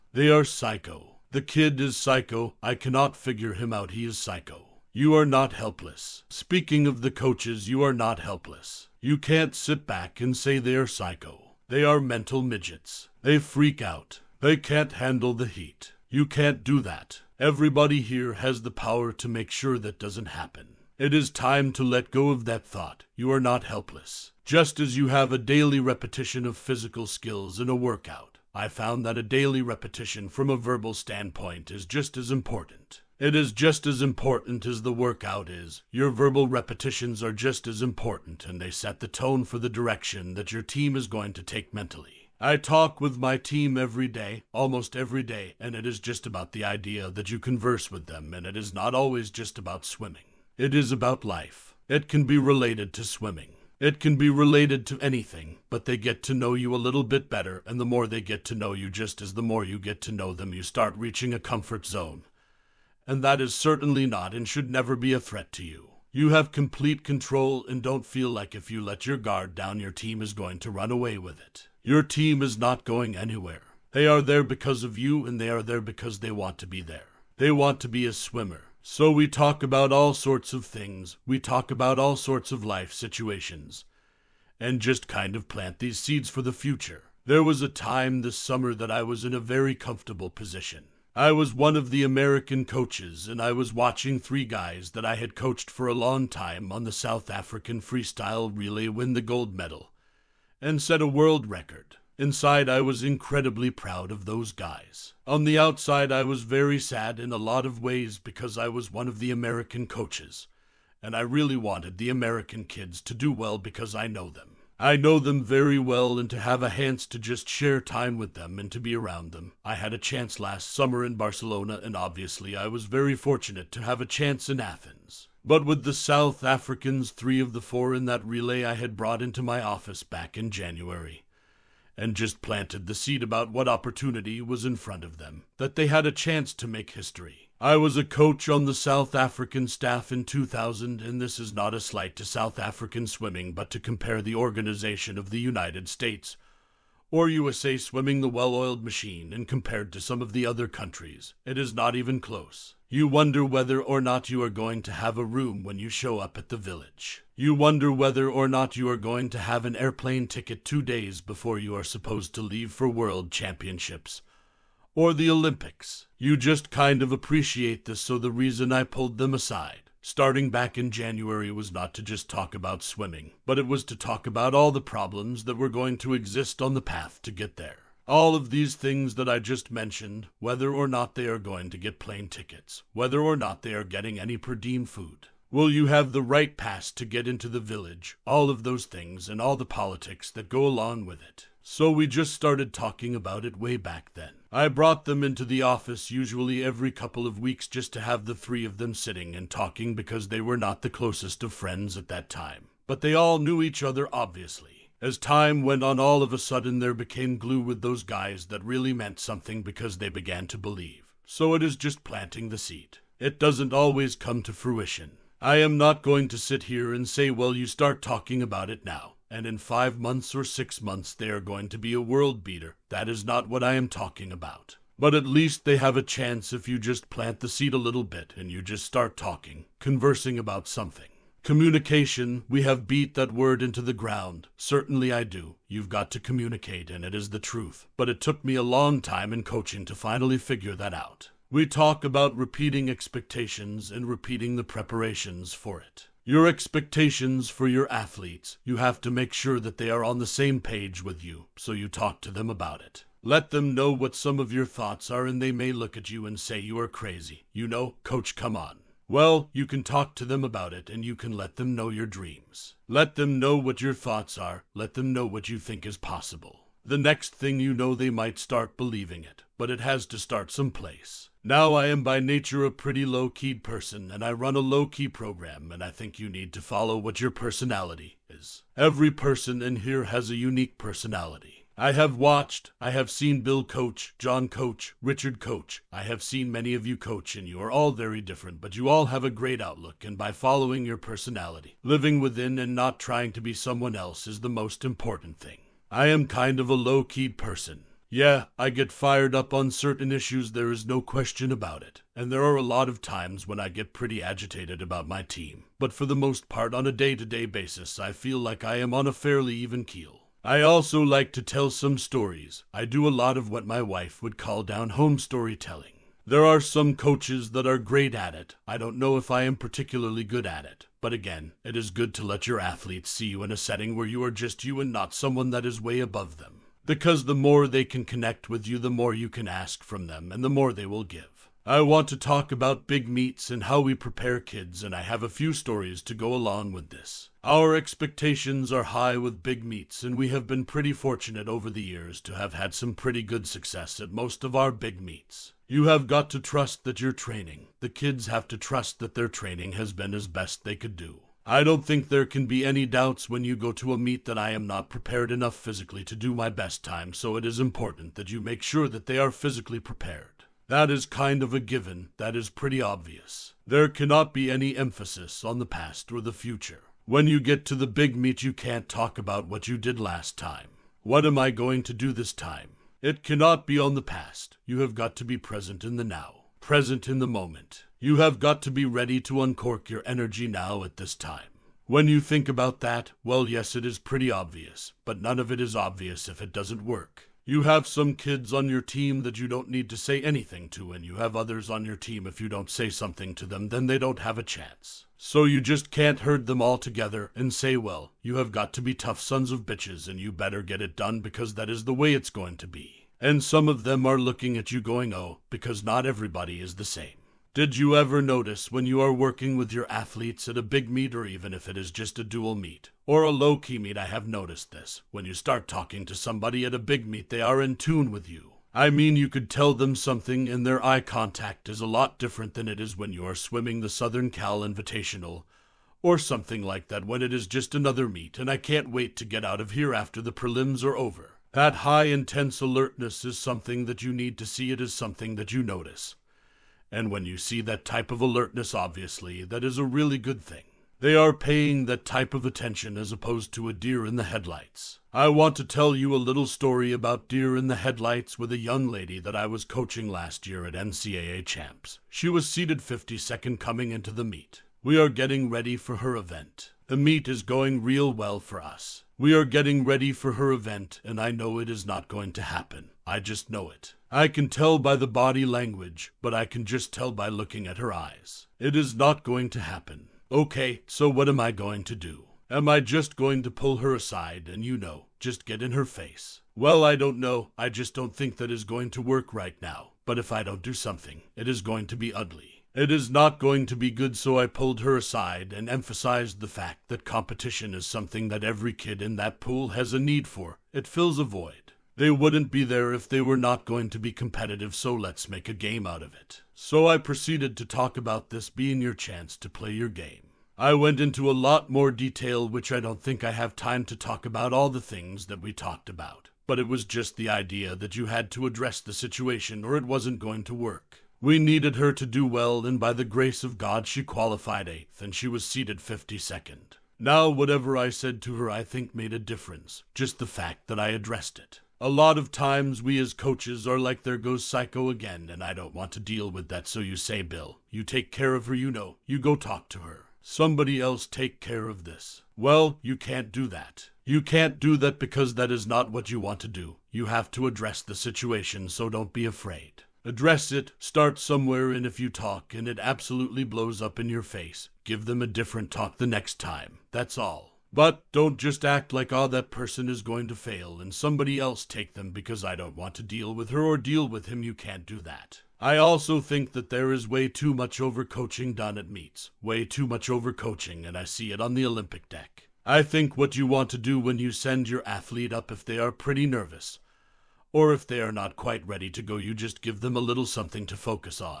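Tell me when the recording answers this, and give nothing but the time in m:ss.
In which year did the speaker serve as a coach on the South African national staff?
2:20.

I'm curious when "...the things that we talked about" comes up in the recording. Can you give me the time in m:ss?
8:24.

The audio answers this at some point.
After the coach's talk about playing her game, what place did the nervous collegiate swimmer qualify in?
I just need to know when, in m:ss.
8:34.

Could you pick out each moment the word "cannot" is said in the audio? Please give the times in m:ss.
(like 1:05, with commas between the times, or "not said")
0:02, 6:03, 6:13.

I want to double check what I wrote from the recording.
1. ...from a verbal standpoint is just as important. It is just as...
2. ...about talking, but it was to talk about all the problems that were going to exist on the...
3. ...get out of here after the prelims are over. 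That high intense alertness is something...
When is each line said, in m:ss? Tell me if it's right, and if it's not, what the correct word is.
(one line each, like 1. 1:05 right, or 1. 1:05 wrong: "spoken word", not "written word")
1. 0:30 right
2. 2:52 wrong: "swimming", not "talking"
3. 7:09 right.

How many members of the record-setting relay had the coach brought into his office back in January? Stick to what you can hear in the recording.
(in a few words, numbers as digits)
3.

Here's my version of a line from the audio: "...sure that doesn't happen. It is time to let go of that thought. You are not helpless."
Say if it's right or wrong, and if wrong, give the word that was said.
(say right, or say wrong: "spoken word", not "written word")
right.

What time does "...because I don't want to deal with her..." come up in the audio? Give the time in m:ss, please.
9:12.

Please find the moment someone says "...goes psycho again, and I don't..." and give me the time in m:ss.
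8:44.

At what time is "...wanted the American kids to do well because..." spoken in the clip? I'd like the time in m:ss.
1:51.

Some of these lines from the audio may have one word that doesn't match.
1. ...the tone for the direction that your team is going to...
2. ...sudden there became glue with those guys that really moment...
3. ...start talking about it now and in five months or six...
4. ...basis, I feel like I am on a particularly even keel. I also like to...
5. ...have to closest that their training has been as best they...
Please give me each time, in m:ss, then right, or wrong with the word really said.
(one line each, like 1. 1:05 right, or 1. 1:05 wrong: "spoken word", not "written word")
1. 0:38 right
2. 3:26 wrong: "meant", not "moment"
3. 3:37 right
4. 5:07 wrong: "fairly", not "particularly"
5. 5:48 wrong: "trust", not "closest".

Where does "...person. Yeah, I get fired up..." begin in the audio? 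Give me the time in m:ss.
4:57.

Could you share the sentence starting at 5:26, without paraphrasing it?
Because the more they can connect with you, the more you can ask from them, and the more they will give.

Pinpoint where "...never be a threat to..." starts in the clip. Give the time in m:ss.
1:04.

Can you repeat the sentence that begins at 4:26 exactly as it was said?
The next thing you know, they might start believing it, but it has to start someplace.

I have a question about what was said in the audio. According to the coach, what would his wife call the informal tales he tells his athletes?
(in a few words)
down home storytelling.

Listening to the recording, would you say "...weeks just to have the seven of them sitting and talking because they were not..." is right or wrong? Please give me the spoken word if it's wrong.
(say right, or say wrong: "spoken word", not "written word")
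wrong: "three", not "seven".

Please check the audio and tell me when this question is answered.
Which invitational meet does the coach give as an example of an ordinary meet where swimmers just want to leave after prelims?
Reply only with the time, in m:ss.
7:03.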